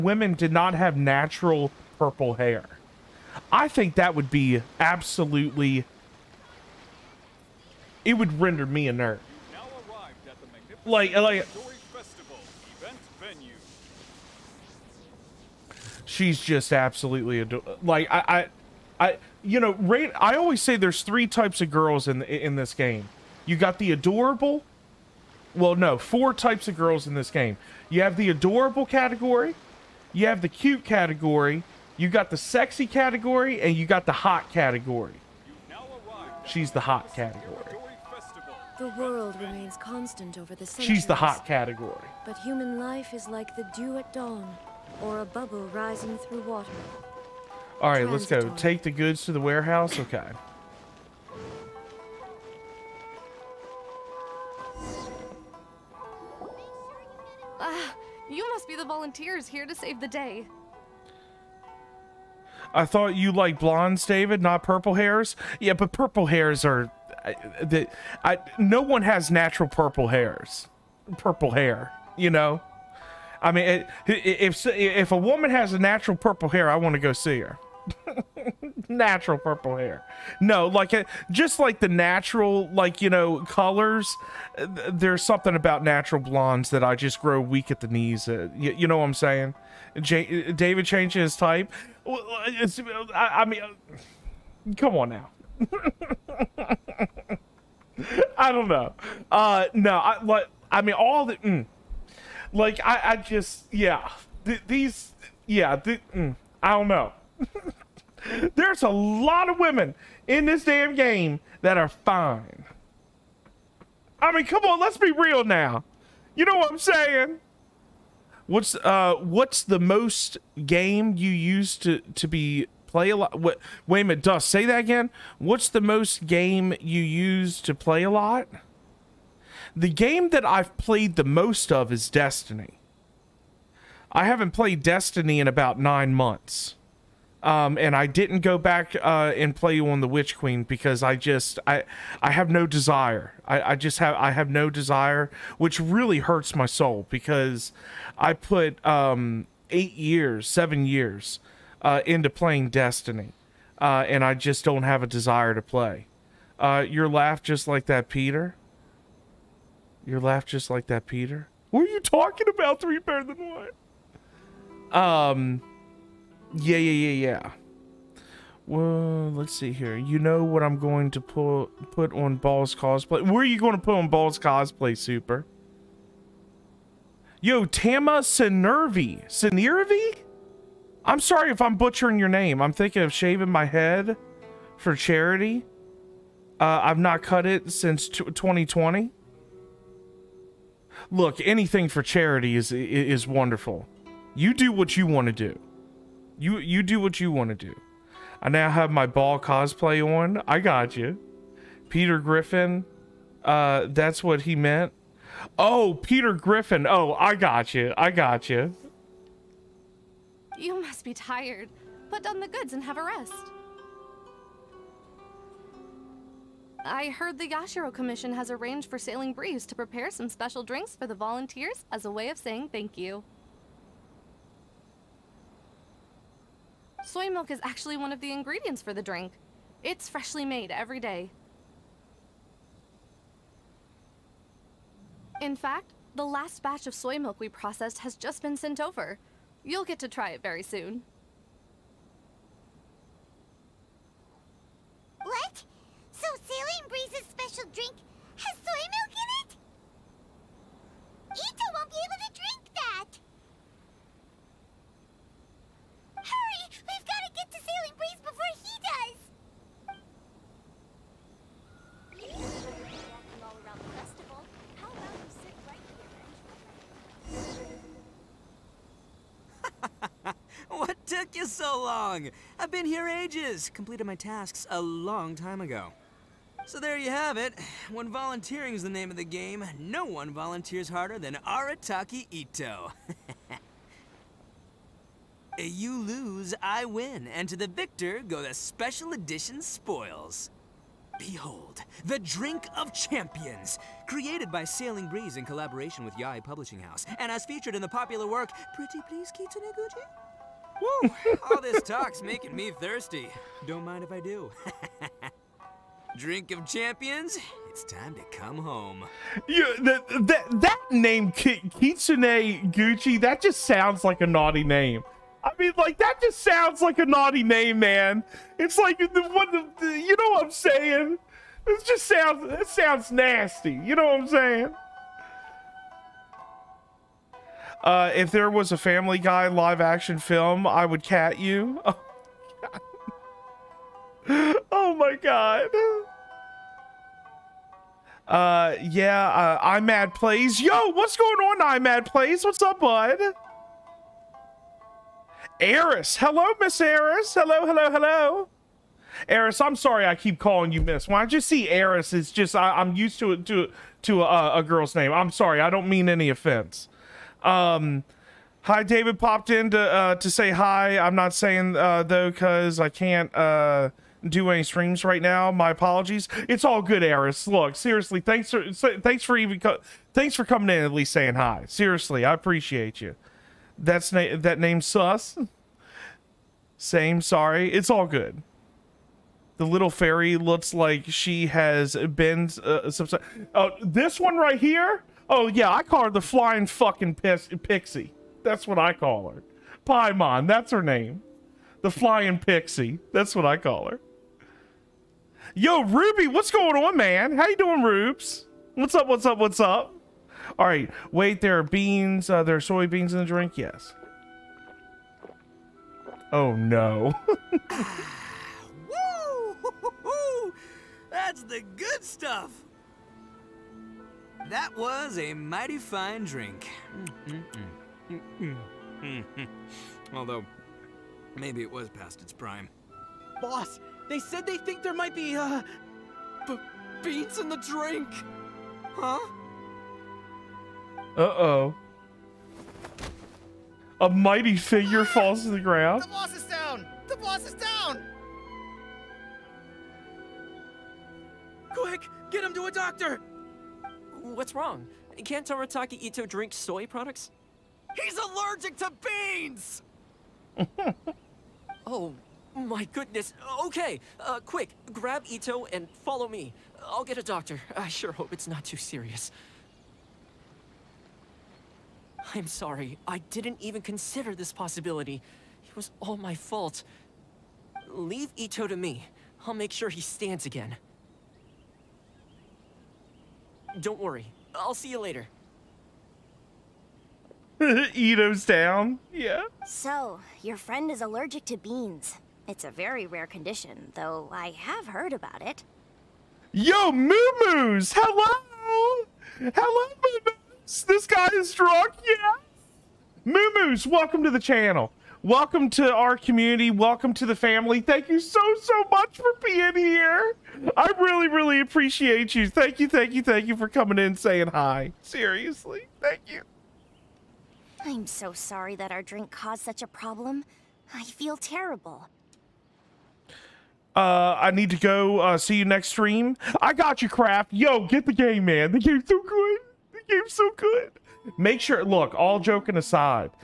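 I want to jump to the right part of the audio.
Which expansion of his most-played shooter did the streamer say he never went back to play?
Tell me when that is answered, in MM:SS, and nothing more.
02:20.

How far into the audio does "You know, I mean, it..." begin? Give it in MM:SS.
01:12.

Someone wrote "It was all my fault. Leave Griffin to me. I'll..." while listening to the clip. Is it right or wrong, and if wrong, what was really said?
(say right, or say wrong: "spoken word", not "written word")
wrong: "Ito", not "Griffin".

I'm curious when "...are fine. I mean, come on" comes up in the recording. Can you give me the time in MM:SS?
01:51.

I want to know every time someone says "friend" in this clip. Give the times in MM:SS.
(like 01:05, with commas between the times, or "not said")
08:00.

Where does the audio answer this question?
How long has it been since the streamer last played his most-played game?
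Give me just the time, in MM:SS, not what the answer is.
02:15.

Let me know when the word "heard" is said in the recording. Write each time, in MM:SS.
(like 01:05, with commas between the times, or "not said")
03:37, 08:04.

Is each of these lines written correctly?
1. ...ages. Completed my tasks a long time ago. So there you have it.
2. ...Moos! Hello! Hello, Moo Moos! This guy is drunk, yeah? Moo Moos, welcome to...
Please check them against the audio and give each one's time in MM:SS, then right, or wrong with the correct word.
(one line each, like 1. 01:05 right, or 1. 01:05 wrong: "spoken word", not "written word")
1. 04:33 right
2. 08:07 right.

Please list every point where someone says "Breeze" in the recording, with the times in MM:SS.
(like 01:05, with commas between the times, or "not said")
03:39, 04:55.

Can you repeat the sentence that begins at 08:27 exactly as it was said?
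I'm so sorry that our drink caused such a problem.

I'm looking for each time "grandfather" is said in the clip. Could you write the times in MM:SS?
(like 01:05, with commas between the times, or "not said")
not said.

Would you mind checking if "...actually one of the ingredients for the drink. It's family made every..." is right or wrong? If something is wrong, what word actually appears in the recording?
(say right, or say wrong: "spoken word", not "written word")
wrong: "freshly", not "family".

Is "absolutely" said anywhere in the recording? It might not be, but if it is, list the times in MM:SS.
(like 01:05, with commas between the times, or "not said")
00:04, 00:16.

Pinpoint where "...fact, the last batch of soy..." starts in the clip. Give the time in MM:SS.
03:55.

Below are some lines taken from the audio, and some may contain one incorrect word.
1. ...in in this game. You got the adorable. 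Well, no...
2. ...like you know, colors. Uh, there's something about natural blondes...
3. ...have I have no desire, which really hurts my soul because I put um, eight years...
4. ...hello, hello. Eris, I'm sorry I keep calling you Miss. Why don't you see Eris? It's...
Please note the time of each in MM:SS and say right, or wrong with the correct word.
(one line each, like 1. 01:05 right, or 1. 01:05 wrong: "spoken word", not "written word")
1. 00:22 right
2. 01:22 right
3. 02:23 right
4. 05:47 right.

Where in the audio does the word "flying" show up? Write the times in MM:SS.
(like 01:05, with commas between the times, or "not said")
06:26, 06:31.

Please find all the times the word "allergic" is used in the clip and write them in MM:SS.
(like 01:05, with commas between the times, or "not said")
07:28, 08:01.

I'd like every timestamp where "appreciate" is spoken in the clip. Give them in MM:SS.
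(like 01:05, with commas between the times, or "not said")
06:12, 08:21.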